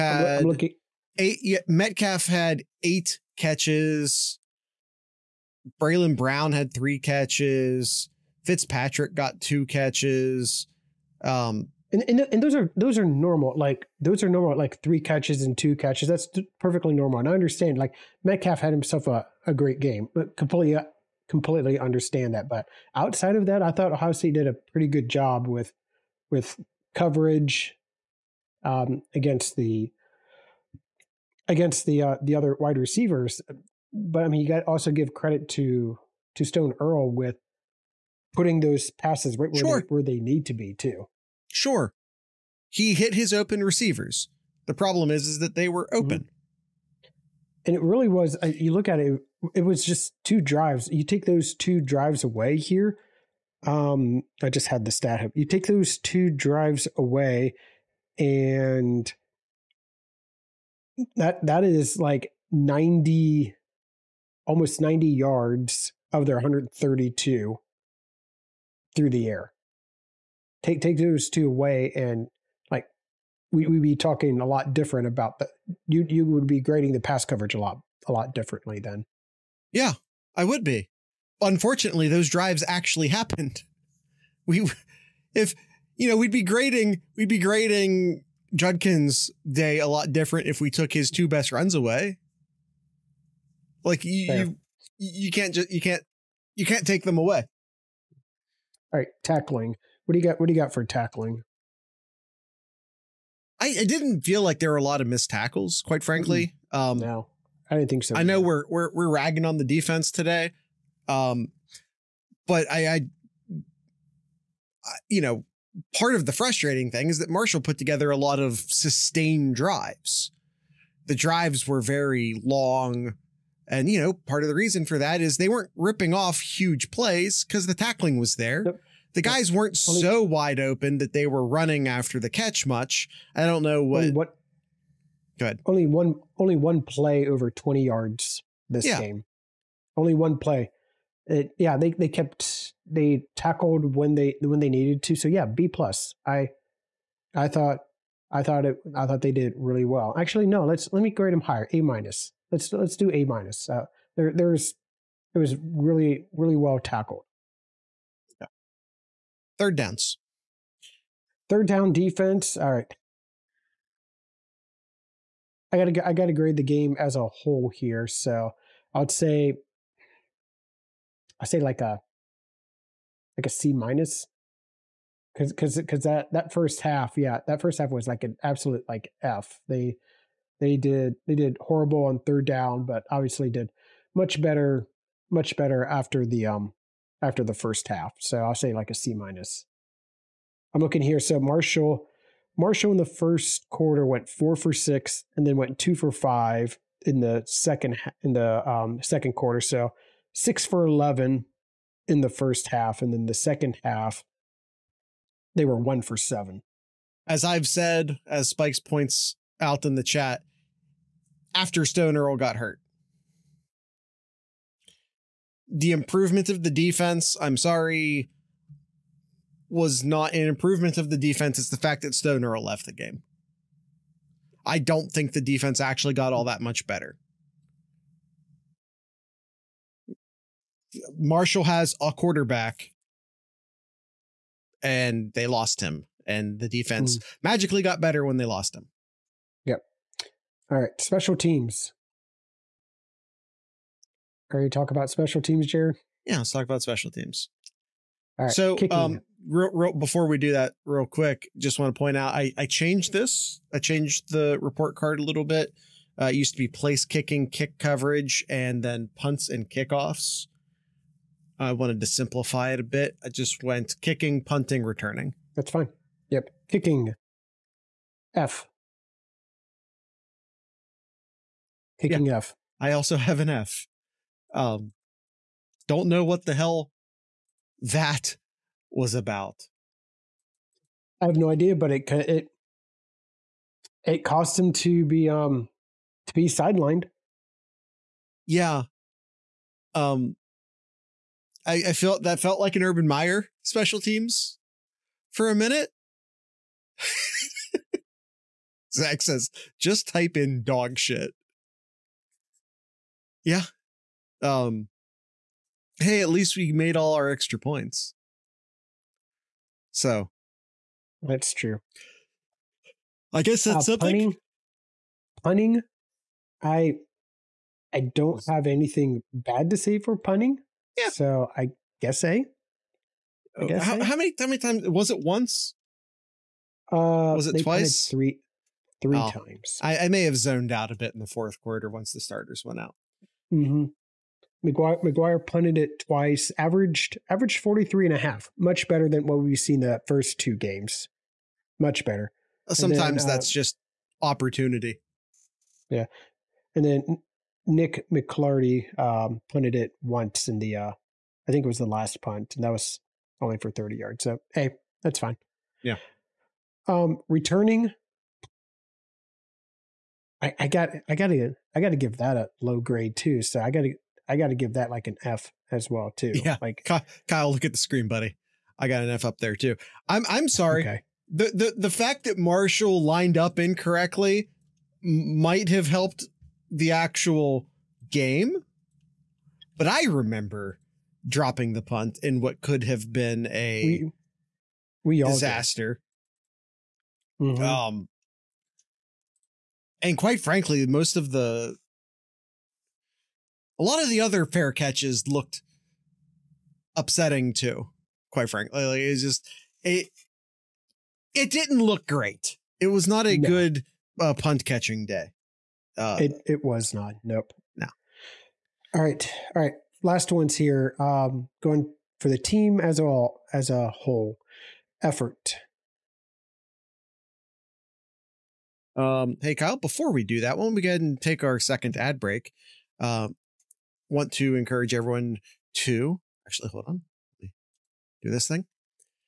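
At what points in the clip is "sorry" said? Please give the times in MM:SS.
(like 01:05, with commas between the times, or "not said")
03:37, 06:10.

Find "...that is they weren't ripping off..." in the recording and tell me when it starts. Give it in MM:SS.
02:04.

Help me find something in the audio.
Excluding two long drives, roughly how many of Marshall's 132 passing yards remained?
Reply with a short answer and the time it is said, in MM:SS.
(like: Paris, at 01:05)
almost 90, at 01:04.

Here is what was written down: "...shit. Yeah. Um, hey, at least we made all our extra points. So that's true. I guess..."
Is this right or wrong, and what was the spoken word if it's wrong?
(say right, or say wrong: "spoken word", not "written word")
right.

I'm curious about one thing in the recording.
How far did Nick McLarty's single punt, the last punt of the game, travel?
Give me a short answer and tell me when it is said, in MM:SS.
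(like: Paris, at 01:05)
30 yards, at 05:53.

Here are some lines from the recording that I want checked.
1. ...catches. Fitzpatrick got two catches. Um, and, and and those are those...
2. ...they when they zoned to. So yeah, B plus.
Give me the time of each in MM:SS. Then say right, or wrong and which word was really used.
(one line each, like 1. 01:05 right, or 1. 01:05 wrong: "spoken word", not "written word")
1. 00:06 right
2. 02:24 wrong: "needed", not "zoned".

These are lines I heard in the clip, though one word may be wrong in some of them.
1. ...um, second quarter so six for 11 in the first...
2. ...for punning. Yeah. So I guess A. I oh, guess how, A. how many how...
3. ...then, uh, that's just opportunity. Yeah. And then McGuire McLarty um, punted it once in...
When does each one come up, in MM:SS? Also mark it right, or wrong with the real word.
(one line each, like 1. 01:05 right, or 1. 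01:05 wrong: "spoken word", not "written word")
1. 03:18 right
2. 05:19 right
3. 05:43 wrong: "Nick", not "McGuire".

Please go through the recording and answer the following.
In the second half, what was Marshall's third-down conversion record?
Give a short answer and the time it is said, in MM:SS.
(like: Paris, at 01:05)
1 for 7, at 03:25.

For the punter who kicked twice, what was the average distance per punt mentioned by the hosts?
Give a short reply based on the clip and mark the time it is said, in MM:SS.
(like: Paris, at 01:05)
43.5, at 05:37.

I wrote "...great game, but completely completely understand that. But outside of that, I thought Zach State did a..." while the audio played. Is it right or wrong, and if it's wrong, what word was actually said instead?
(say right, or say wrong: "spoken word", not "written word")
wrong: "Ohio", not "Zach".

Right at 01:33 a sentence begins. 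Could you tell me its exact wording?
Like you, you, you can't just you can't you can't take them away.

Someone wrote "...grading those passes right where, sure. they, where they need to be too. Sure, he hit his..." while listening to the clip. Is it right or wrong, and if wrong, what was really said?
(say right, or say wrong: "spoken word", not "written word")
wrong: "putting", not "grading".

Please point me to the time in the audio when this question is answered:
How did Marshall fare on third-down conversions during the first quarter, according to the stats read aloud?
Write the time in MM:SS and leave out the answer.
03:14.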